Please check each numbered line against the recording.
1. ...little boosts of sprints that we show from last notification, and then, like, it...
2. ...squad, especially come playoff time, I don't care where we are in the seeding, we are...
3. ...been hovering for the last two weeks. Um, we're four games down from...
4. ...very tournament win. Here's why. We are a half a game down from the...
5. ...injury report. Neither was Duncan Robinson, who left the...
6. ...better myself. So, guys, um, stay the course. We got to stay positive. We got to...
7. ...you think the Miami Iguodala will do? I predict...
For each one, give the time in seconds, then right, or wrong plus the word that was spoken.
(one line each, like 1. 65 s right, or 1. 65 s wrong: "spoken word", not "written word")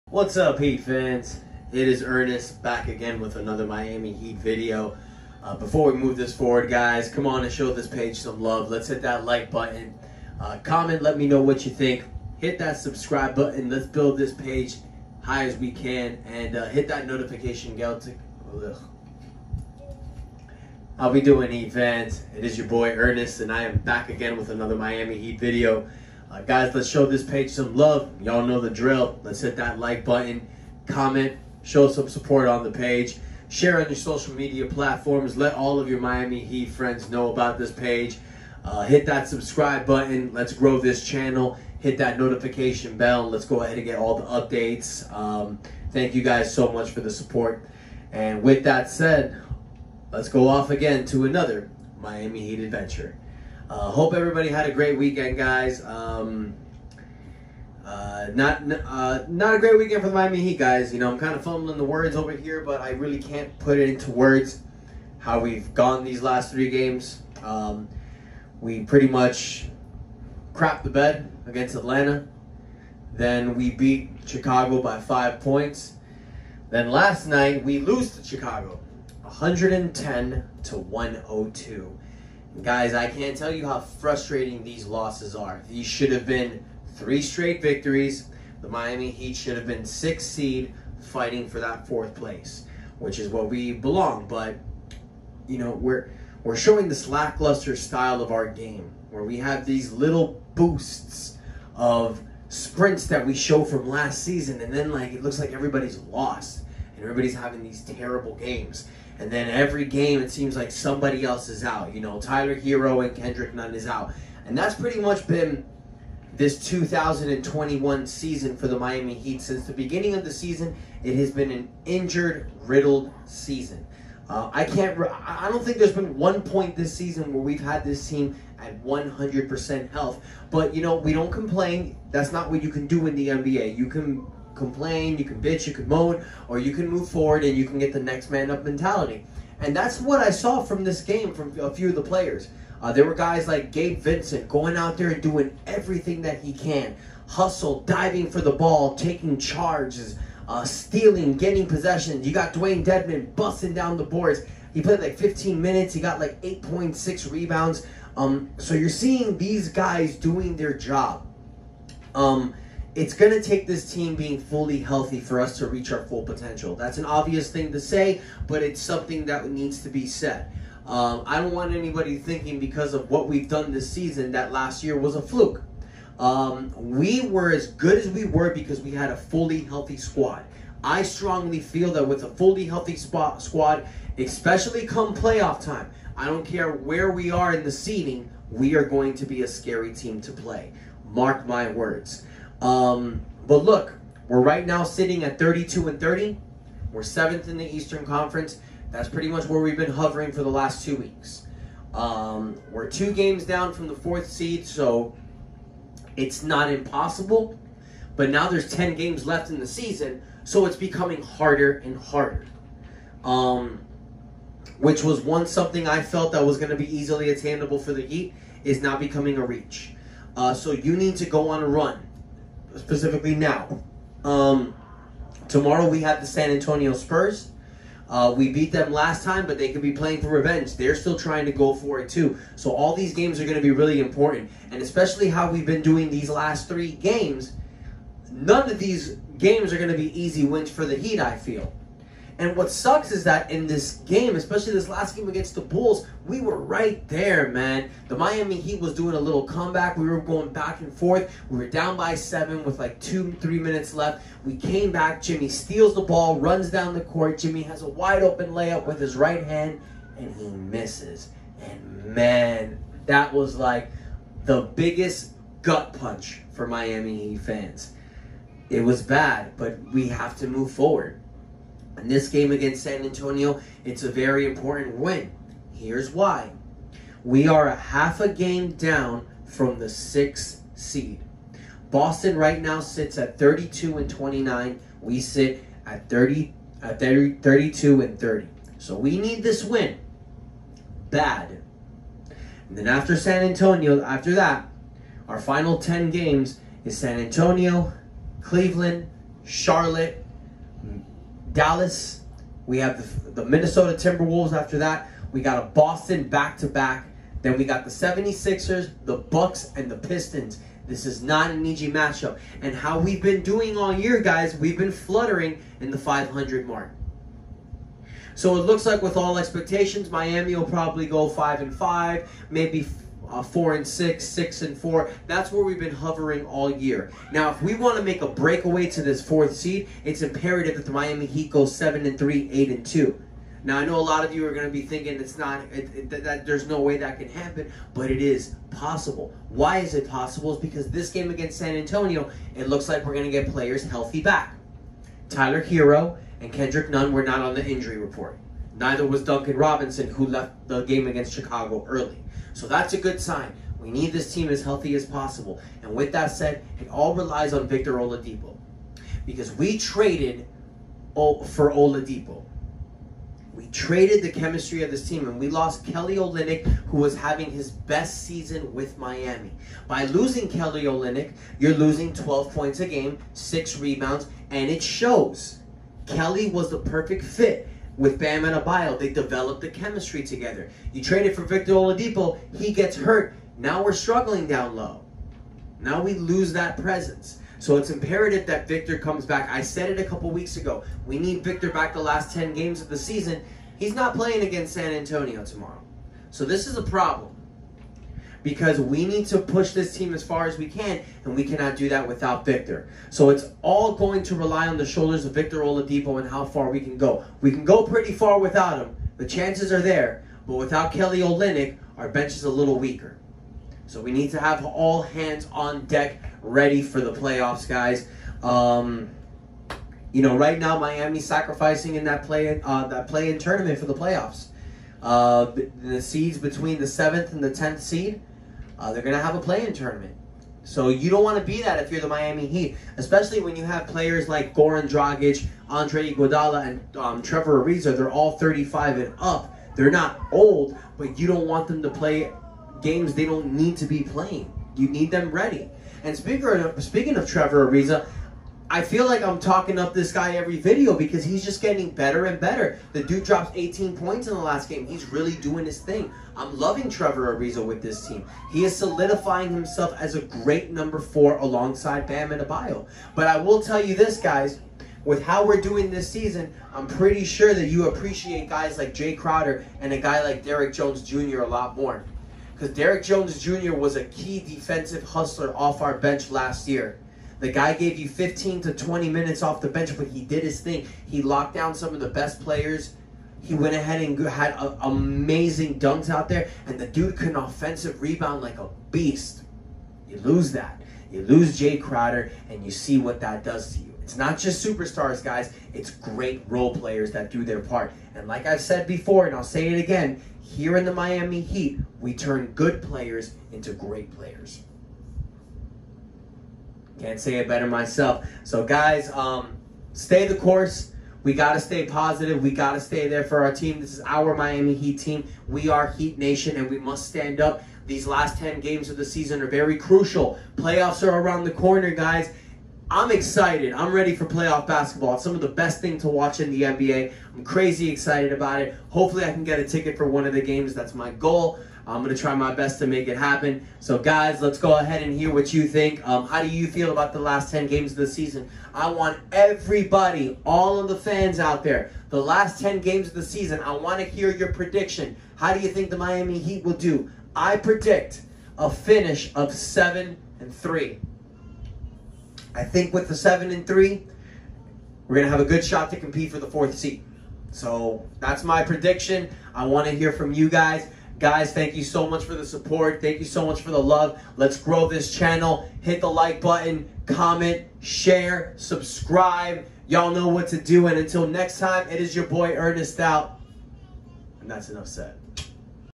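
1. 99 s wrong: "season", not "notification"
2. 183 s right
3. 199 s wrong: "two", not "four"
4. 274 s wrong: "important", not "tournament"
5. 347 s right
6. 507 s right
7. 545 s wrong: "Heat", not "Iguodala".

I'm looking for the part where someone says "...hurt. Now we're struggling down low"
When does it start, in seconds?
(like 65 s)
382 s.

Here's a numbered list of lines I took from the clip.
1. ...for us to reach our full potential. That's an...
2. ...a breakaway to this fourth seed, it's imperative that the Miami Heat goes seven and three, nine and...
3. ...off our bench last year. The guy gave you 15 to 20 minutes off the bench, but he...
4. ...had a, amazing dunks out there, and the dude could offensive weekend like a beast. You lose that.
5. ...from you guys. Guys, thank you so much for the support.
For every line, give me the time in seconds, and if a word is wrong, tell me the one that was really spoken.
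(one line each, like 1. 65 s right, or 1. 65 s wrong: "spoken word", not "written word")
1. 165 s right
2. 328 s wrong: "eight", not "nine"
3. 475 s right
4. 484 s wrong: "rebound", not "weekend"
5. 560 s right.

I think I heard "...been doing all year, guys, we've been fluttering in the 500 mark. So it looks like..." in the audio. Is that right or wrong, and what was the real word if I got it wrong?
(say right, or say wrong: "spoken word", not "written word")
right.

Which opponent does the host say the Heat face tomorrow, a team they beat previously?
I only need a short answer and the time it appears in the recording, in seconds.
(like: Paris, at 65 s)
San Antonio Spurs, at 226 s.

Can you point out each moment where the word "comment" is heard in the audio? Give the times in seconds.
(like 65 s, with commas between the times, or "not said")
10 s, 30 s, 567 s.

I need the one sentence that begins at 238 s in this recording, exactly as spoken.
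None of these games are going to be easy wins for the Heat.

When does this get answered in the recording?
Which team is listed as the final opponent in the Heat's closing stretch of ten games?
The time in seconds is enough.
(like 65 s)
309 s.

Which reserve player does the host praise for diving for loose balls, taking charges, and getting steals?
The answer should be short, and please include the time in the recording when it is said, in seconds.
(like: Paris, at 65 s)
Gabe Vincent, at 143 s.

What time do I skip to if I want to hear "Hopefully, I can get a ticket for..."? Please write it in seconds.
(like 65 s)
528 s.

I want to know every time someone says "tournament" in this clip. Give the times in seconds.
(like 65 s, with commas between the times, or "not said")
423 s, 429 s.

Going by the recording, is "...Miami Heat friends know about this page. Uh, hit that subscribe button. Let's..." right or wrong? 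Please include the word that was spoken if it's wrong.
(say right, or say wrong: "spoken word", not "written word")
right.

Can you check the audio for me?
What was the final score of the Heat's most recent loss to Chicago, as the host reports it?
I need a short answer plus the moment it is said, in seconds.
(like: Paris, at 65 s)
110 to 102, at 79 s.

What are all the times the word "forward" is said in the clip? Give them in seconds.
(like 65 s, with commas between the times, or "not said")
6 s, 137 s, 270 s.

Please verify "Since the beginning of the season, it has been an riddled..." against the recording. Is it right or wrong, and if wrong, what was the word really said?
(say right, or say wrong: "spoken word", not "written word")
wrong: "injured", not "riddled".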